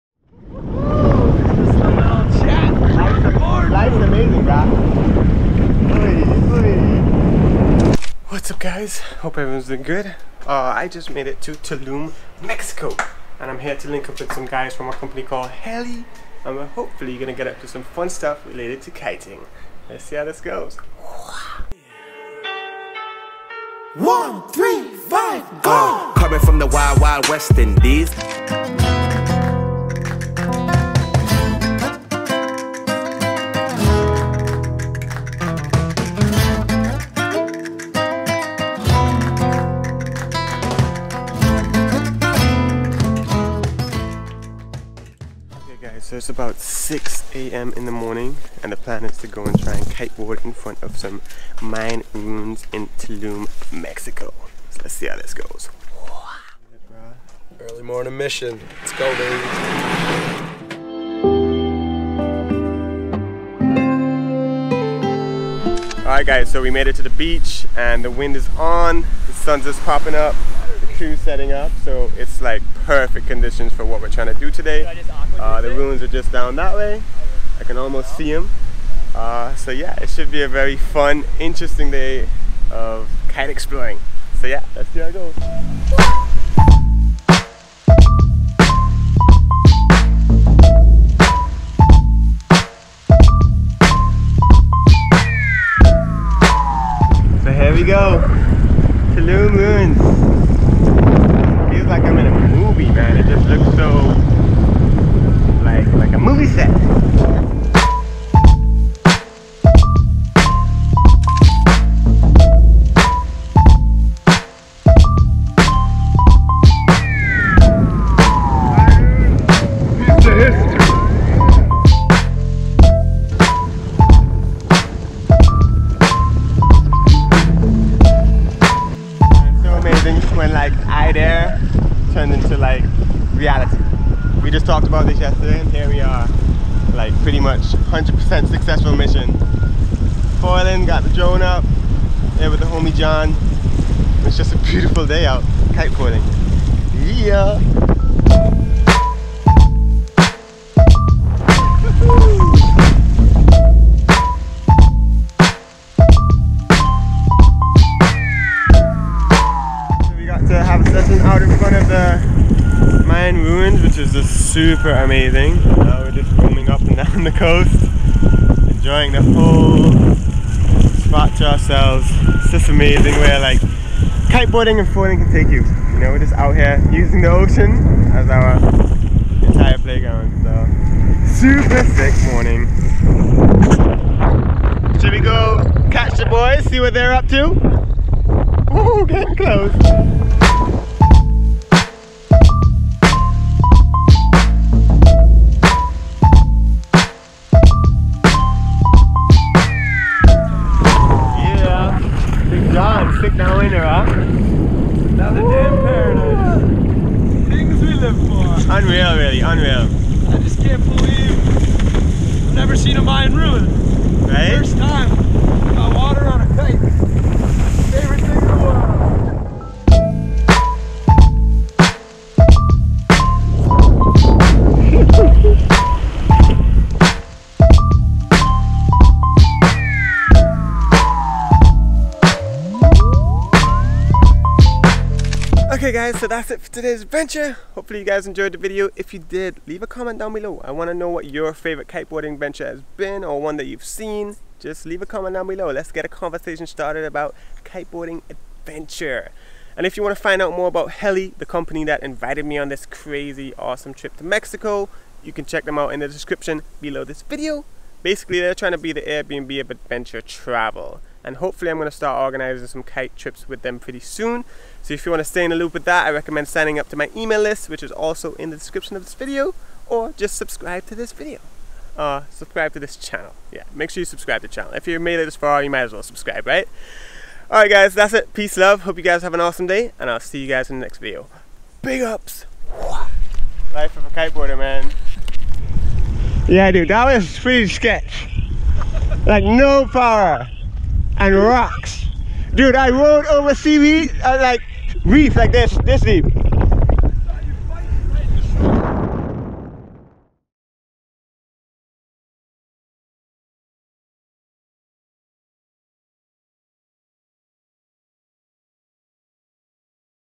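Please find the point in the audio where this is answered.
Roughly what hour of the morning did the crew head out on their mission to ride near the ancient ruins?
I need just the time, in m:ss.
0:46.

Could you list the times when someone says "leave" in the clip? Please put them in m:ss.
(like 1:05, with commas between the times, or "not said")
3:59, 4:04.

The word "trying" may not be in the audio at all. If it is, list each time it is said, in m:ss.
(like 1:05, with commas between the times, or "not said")
1:14, 4:18.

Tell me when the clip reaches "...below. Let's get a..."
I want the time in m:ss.
4:05.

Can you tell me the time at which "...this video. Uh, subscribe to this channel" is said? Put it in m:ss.
4:30.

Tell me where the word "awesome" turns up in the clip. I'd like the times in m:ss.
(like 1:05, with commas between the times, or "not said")
4:13, 4:39.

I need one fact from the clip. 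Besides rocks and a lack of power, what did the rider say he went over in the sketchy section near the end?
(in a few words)
seaweed.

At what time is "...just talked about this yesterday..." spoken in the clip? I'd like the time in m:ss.
2:14.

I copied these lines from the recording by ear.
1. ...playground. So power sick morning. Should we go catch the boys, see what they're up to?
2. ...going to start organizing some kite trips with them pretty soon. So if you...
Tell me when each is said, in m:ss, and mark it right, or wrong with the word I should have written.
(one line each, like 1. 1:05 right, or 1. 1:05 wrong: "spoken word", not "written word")
1. 2:59 wrong: "super", not "power"
2. 4:21 right.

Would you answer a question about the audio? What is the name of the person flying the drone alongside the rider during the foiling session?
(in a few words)
John.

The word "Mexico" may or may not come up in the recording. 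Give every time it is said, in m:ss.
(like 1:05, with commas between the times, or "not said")
0:12, 0:53, 4:14.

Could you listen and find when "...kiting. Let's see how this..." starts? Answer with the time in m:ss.
0:18.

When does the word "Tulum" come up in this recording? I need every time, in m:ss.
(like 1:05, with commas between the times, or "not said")
0:11, 0:52, 1:39.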